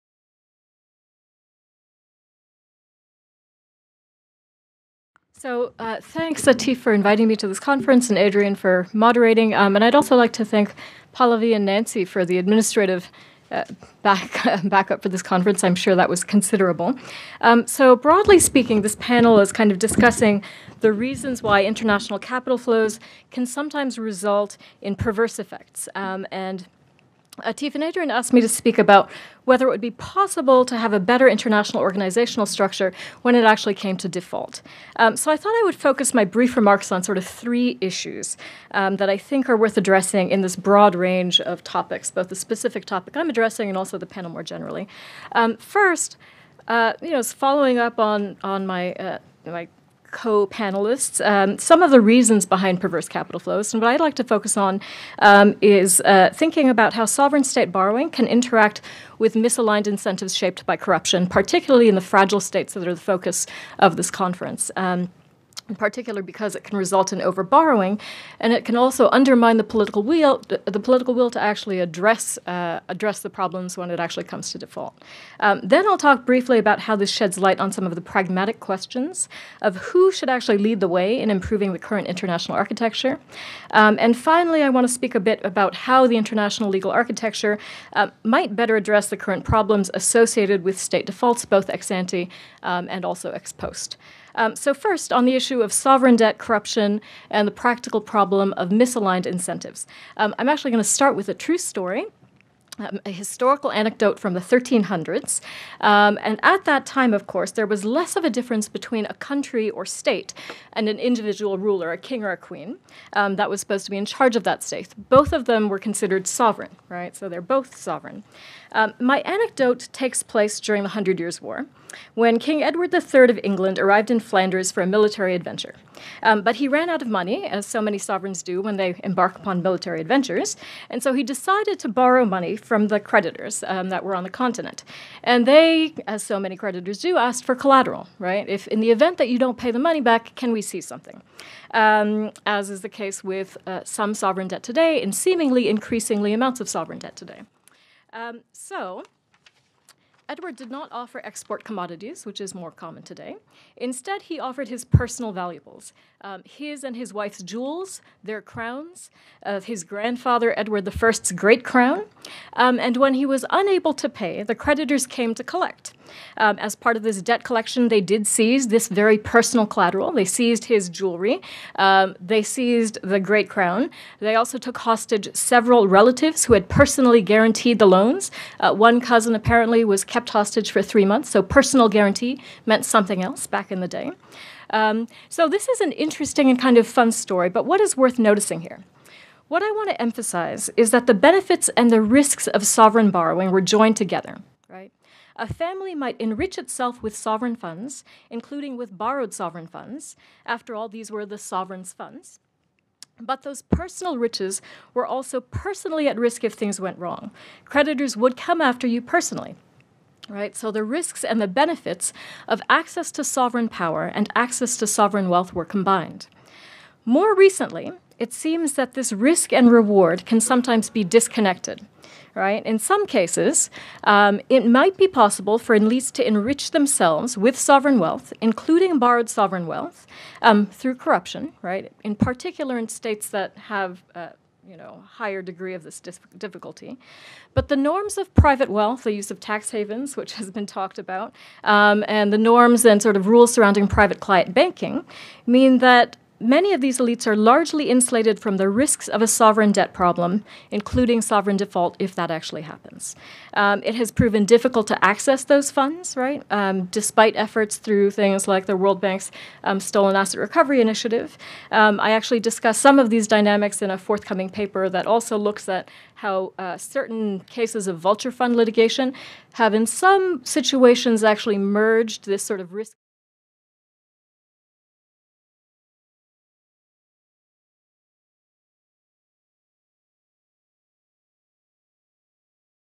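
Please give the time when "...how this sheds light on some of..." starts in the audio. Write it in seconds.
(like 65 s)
76 s.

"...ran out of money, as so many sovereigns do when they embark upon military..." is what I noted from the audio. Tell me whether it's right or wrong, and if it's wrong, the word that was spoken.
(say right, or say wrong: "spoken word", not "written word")
right.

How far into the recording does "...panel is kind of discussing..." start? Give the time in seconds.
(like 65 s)
18 s.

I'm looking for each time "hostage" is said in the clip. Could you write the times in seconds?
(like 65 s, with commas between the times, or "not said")
174 s, 180 s.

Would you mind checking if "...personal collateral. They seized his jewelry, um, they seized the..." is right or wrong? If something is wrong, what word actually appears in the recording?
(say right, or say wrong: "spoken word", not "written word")
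right.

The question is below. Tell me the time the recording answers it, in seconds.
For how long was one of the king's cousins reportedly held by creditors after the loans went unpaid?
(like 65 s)
180 s.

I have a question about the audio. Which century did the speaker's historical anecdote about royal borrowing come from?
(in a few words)
1300s.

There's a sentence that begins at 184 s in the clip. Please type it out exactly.
Um, so this is an interesting and kind of fun story, but what is worth noticing here?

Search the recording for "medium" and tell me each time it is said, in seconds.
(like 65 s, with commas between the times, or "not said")
not said.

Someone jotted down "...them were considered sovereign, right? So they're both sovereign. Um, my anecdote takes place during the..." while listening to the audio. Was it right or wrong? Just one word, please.
right.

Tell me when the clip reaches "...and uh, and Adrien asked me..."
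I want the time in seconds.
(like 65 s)
26 s.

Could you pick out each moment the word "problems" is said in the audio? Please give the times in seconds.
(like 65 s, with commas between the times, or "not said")
73 s, 89 s, 98 s, 249 s.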